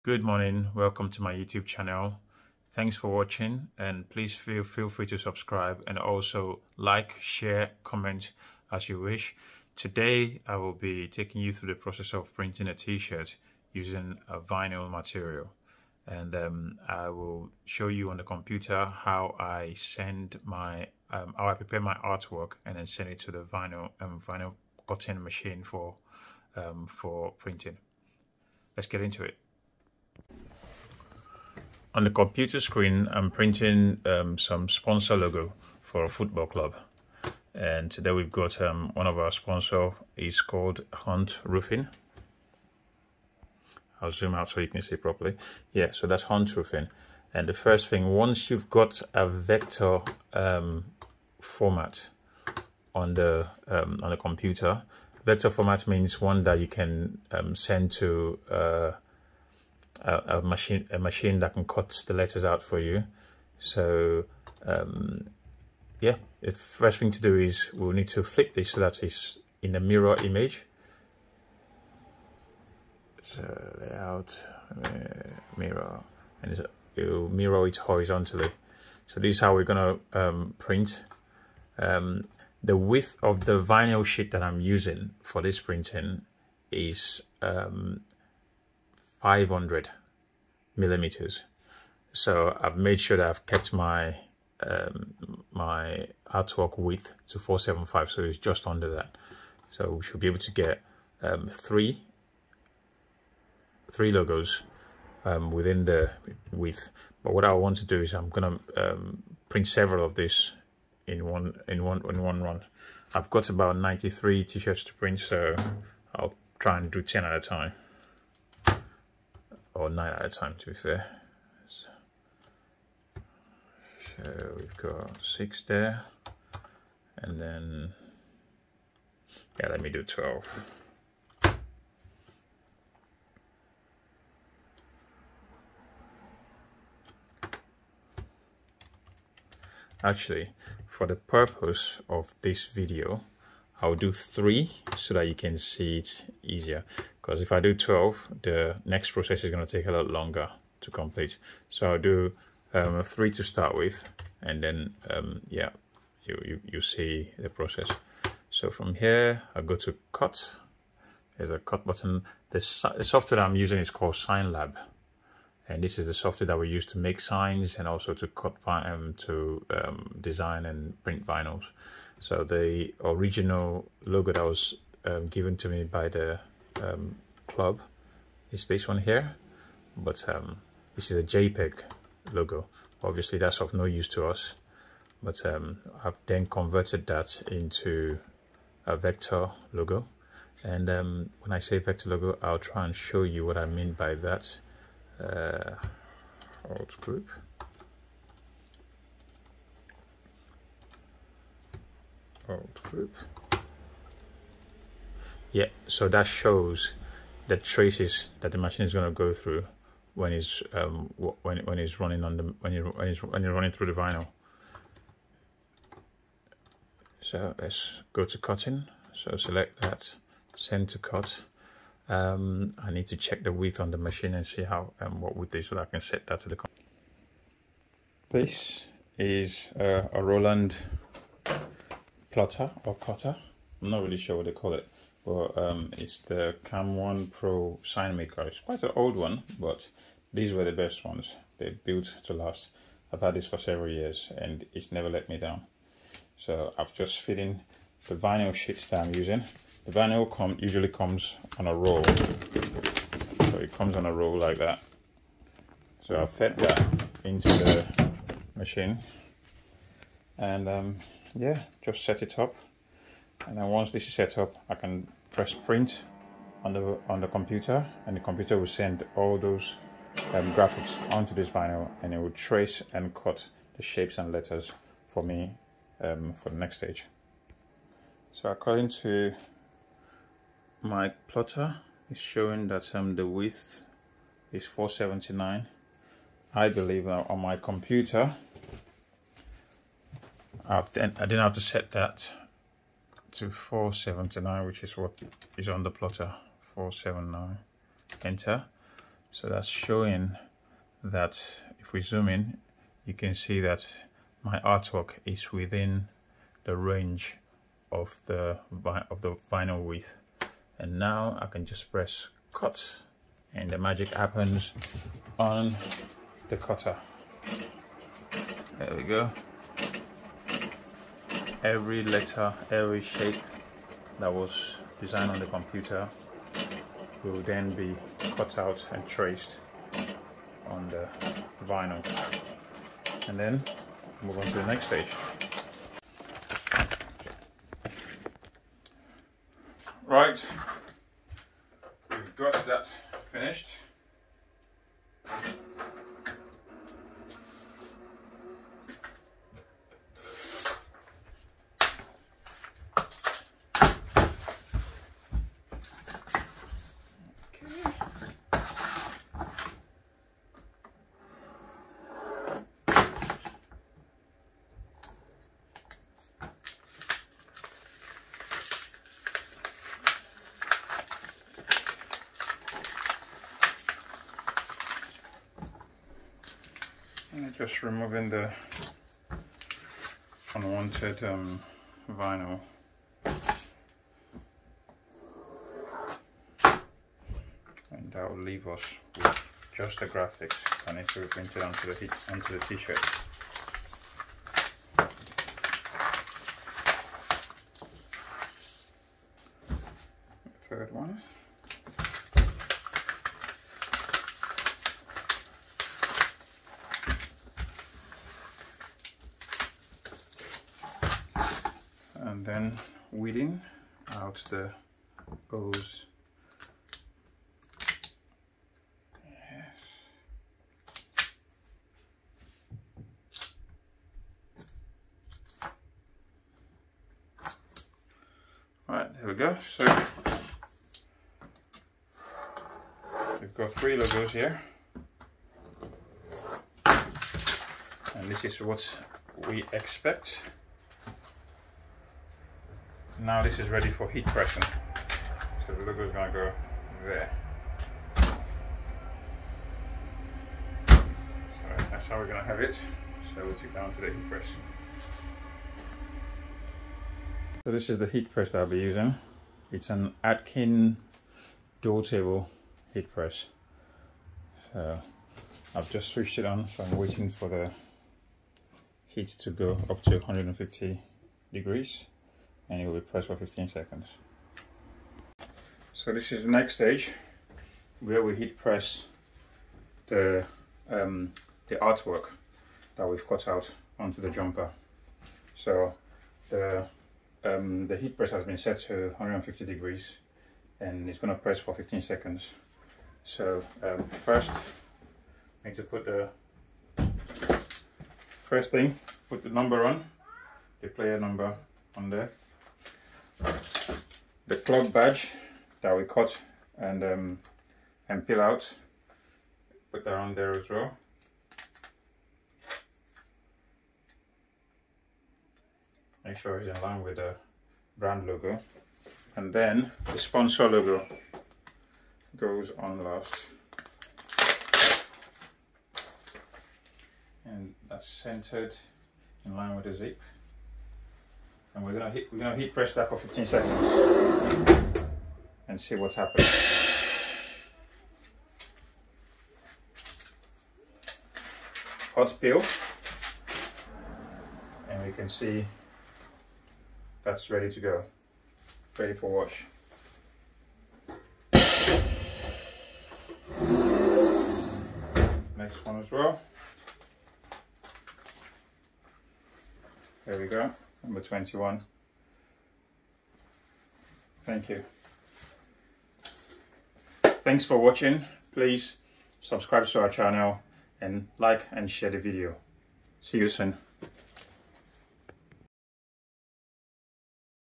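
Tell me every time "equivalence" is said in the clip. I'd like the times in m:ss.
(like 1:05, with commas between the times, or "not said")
not said.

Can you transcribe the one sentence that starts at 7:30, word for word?
So that's how we're going to have it.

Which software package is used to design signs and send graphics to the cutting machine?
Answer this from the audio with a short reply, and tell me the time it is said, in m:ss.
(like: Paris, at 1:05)
SignLab, at 2:44.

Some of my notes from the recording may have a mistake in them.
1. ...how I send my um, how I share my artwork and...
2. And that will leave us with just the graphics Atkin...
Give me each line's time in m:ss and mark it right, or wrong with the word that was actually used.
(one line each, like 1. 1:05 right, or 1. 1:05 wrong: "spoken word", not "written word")
1. 0:18 wrong: "prepare", not "share"
2. 6:27 wrong: "And", not "Atkin".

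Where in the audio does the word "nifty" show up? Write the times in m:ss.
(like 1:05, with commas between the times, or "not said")
not said.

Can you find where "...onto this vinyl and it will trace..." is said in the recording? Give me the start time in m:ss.
4:31.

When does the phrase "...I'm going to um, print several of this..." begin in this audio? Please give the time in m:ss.
1:48.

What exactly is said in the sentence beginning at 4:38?
So according to my plotter is showing that um, the width is 479.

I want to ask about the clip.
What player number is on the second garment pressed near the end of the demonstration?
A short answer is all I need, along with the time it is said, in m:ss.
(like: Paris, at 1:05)
21, at 9:21.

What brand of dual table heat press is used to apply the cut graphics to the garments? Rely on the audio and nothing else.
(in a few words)
Atkin.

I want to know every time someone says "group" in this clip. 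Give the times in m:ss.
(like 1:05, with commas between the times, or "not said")
3:17, 3:22.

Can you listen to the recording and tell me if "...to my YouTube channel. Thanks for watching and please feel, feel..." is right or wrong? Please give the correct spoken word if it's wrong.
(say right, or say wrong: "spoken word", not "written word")
right.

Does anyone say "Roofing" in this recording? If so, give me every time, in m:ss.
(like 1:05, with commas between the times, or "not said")
0:41, 0:46.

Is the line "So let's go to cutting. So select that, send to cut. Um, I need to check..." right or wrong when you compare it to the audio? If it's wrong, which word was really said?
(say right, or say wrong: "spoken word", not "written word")
right.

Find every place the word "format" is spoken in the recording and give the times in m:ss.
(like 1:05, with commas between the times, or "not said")
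0:51, 0:55.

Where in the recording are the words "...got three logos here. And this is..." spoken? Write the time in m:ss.
7:13.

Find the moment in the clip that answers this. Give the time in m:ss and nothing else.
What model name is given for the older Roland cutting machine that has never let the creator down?
3:56.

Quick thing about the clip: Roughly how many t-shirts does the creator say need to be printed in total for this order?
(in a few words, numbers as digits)
93.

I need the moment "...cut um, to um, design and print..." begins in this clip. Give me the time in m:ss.
2:48.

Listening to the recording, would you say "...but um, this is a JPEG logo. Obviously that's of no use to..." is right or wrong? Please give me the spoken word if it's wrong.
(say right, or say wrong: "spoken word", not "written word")
right.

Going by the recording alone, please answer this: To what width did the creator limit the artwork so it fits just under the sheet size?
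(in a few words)
475.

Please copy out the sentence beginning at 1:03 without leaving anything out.
So um, yeah, the first thing to do is we'll need to flip this so that it's in a mirror image.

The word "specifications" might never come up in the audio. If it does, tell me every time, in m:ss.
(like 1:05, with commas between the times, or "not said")
not said.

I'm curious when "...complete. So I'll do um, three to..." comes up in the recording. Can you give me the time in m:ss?
2:30.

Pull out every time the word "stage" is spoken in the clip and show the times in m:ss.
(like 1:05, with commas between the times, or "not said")
4:36, 5:34, 7:56.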